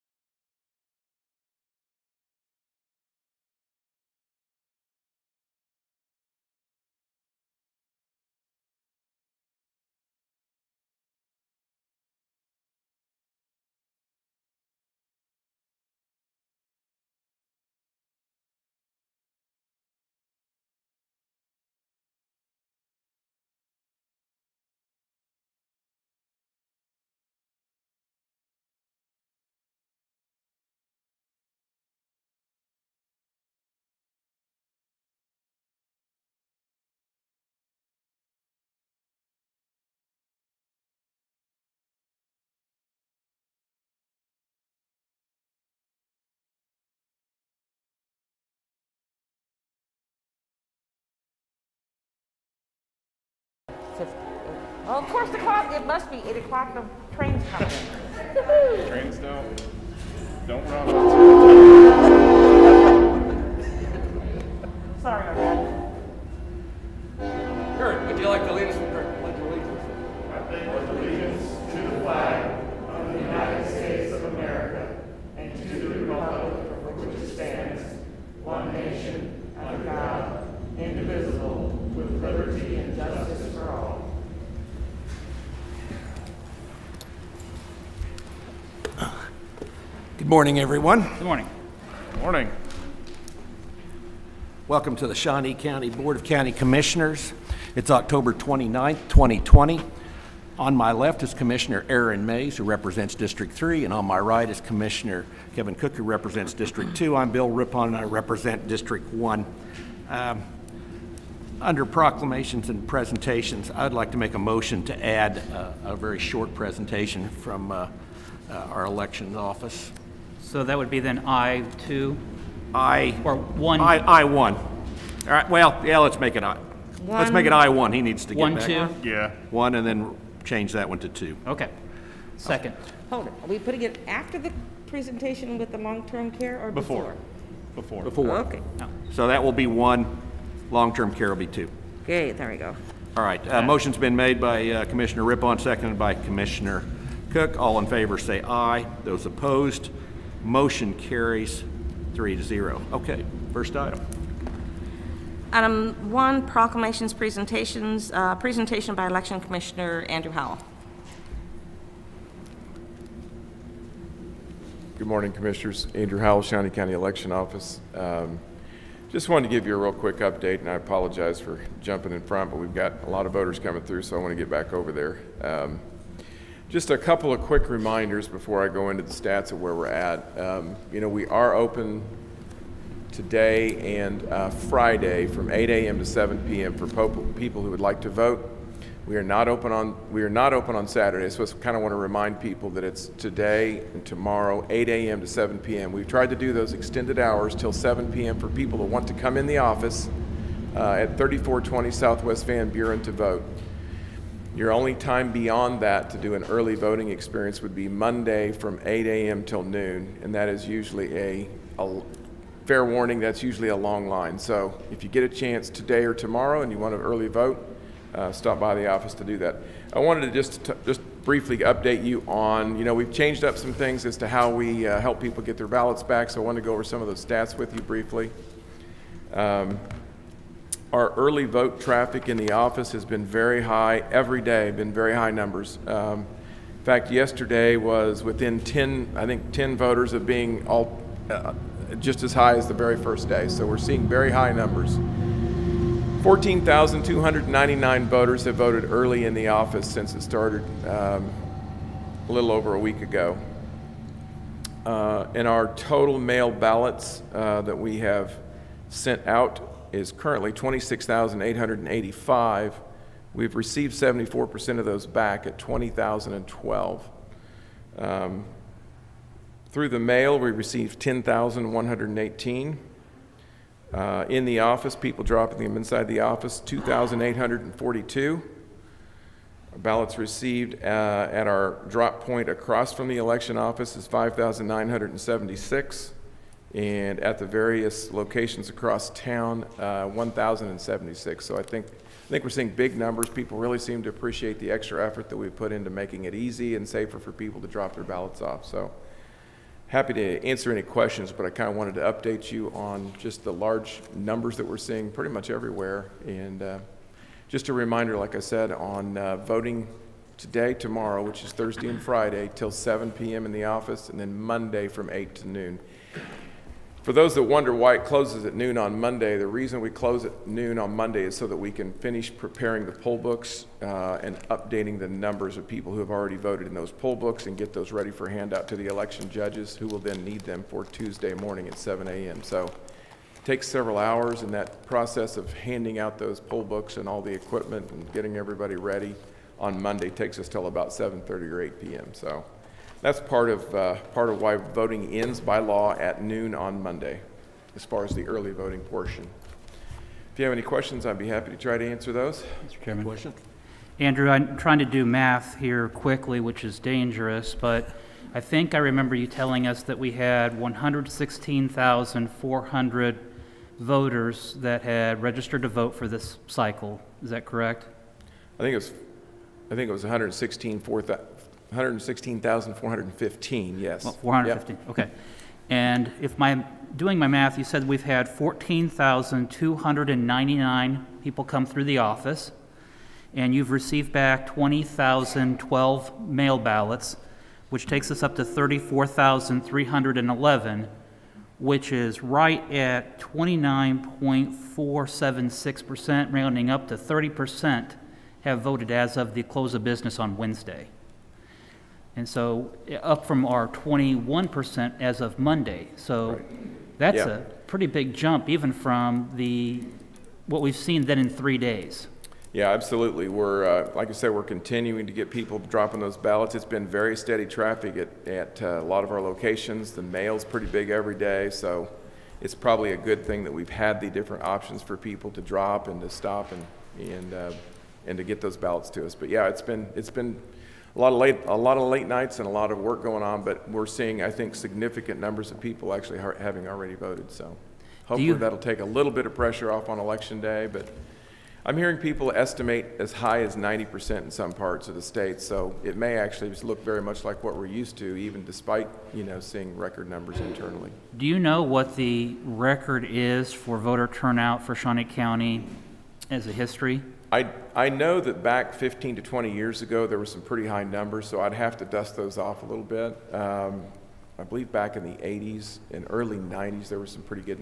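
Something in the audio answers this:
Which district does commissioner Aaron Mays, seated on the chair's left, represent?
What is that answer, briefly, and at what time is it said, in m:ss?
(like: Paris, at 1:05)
District 3, at 1:43.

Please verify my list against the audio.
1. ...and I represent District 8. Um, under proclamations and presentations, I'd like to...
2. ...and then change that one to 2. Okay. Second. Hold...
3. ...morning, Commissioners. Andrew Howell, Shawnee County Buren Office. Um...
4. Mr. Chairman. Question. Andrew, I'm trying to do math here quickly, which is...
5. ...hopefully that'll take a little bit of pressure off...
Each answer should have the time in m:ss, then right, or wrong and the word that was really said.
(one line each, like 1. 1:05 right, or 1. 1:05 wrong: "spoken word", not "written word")
1. 1:47 wrong: "1", not "8"
2. 2:09 right
3. 2:45 wrong: "Election", not "Buren"
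4. 5:52 right
5. 7:18 right.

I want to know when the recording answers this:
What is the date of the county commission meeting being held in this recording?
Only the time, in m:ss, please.
1:37.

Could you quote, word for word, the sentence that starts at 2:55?
Um, just a couple of quick reminders before I go into the stats of where we're at.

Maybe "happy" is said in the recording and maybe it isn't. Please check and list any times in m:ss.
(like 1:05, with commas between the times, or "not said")
4:59, 5:51.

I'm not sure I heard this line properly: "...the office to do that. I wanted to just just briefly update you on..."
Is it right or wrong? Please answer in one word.
right.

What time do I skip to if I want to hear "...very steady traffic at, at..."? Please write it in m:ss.
6:56.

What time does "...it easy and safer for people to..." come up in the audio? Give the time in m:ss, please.
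4:56.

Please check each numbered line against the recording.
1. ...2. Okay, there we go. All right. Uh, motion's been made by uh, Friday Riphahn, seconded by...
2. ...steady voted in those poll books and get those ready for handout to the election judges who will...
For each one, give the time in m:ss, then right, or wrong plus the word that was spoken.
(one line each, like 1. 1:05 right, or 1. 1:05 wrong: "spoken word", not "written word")
1. 2:21 wrong: "Commissioner", not "Friday"
2. 5:26 wrong: "already", not "steady".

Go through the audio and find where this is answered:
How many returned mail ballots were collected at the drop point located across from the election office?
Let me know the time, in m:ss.
4:44.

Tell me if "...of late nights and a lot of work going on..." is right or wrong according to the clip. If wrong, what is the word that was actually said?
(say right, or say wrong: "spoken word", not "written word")
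right.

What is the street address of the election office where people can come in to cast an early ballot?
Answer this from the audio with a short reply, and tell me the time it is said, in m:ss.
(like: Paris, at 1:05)
3420 Southwest Van Buren, at 3:21.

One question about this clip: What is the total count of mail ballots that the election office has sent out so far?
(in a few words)
26,885.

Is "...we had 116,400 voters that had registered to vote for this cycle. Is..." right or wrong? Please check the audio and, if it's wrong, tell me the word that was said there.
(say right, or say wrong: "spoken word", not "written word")
right.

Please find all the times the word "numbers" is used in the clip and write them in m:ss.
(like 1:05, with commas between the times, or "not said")
3:55, 4:04, 4:52, 5:04, 5:25, 7:15, 7:30, 7:40.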